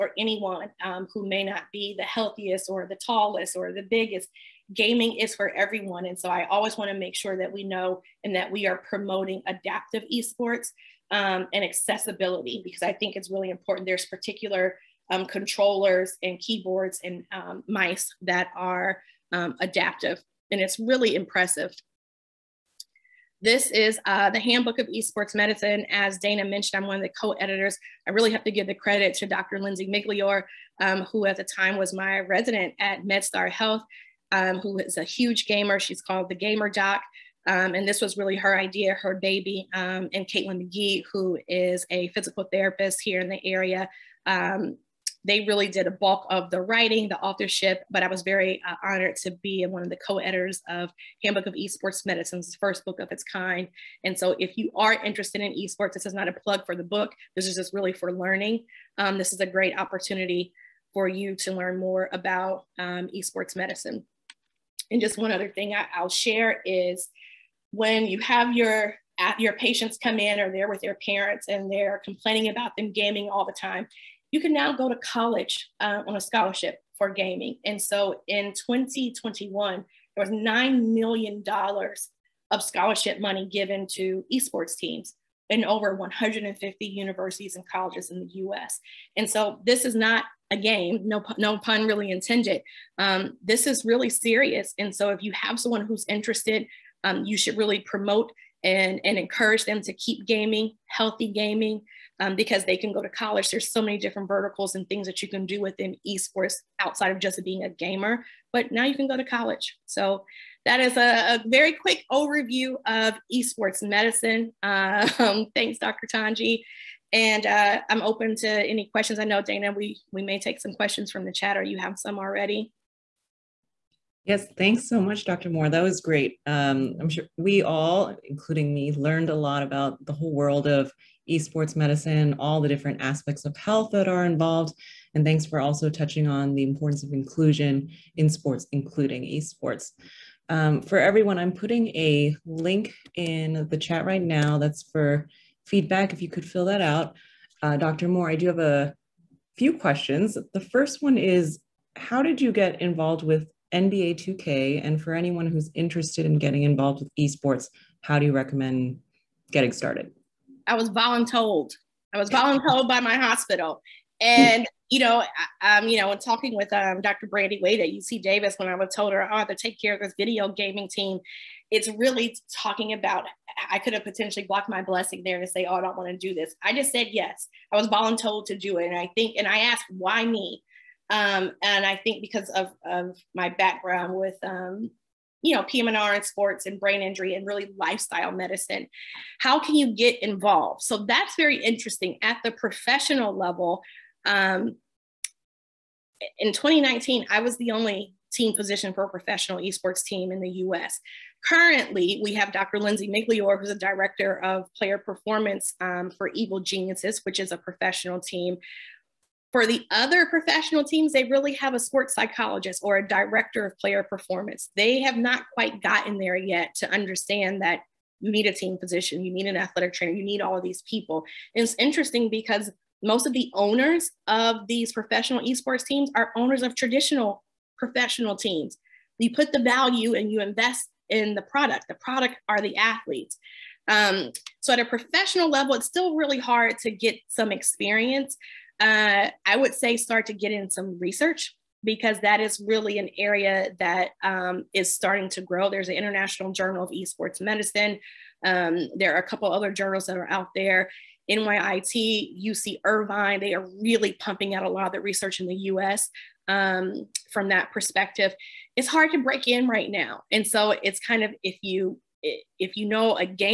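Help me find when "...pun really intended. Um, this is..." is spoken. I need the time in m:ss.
1:31.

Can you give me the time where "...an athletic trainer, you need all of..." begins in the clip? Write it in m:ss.
3:39.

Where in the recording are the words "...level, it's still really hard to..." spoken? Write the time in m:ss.
3:55.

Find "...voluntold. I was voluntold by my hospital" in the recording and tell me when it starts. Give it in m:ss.
2:40.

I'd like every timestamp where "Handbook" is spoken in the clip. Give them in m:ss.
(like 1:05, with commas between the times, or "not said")
0:24, 0:51.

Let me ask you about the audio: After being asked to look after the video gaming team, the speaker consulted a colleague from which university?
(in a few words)
UC Davis.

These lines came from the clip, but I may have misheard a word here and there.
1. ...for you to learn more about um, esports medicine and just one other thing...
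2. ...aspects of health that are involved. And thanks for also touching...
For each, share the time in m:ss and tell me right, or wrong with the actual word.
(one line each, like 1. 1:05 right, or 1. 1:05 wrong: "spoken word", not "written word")
1. 1:00 right
2. 2:13 right.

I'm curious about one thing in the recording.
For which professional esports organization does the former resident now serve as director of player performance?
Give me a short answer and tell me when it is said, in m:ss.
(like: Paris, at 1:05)
Evil Geniuses, at 3:26.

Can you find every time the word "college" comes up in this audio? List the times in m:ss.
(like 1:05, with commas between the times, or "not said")
1:14, 1:27, 1:43, 1:49.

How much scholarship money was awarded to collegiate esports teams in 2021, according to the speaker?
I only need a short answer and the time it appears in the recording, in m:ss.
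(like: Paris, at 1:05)
$9 million, at 1:20.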